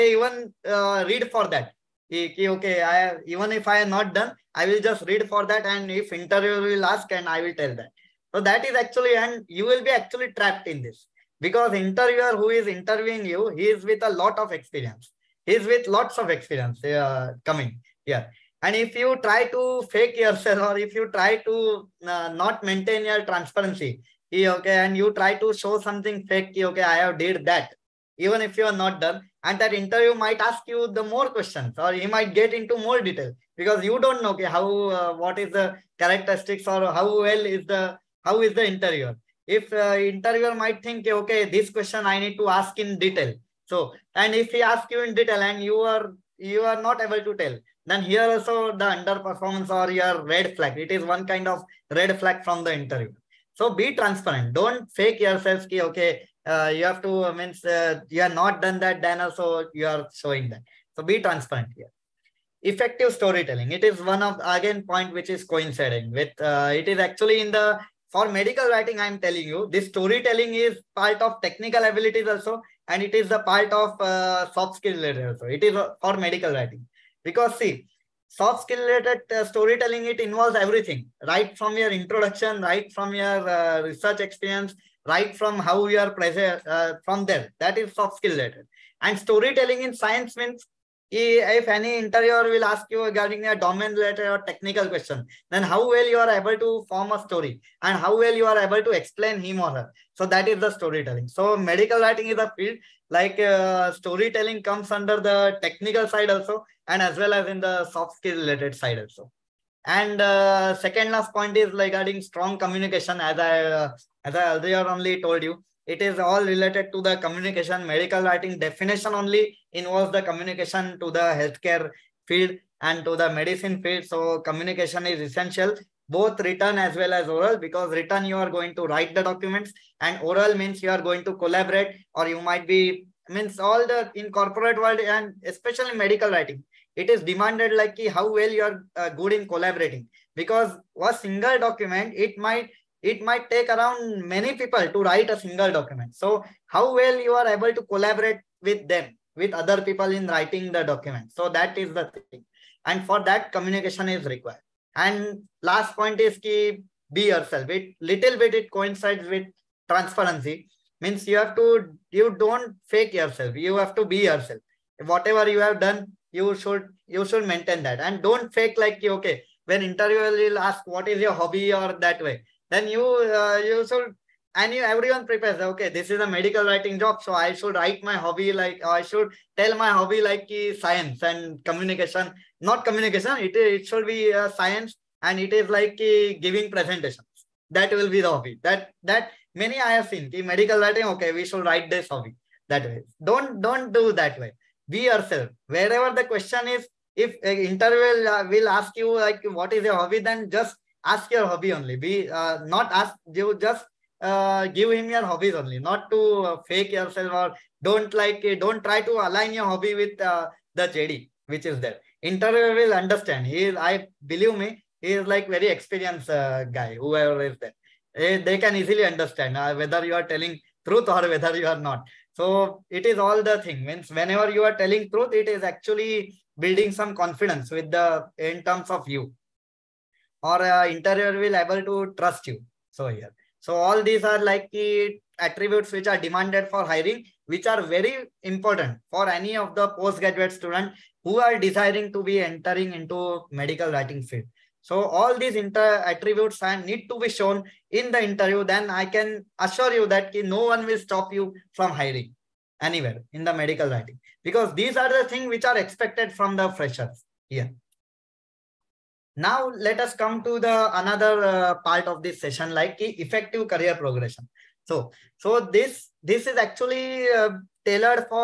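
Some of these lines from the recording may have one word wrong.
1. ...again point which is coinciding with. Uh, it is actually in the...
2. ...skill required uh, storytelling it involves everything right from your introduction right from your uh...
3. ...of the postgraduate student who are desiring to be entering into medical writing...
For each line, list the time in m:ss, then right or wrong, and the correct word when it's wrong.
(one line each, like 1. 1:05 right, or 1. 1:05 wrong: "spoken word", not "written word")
1. 1:04 right
2. 1:18 wrong: "related", not "required"
3. 3:59 right.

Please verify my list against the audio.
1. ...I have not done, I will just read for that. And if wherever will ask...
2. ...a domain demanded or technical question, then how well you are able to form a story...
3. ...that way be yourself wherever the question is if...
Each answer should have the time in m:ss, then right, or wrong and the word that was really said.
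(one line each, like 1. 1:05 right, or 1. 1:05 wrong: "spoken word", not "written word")
1. 0:03 wrong: "interviewer", not "wherever"
2. 1:33 wrong: "related", not "demanded"
3. 3:14 right.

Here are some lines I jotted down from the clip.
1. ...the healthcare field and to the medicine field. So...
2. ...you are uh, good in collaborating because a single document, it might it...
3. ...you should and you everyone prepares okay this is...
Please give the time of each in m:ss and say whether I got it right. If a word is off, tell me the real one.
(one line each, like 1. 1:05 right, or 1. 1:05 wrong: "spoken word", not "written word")
1. 2:01 right
2. 2:18 right
3. 2:53 right.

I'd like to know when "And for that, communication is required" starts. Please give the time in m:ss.
2:32.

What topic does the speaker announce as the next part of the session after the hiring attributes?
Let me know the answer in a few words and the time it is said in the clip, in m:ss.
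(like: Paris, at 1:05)
Effective career progression, at 4:22.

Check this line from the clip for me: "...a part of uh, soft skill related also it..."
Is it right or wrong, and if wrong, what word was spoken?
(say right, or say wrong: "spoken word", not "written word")
right.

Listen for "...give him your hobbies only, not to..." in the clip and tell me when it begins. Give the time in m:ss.
3:24.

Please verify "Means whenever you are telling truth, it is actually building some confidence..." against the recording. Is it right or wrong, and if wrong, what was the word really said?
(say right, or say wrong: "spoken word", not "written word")
right.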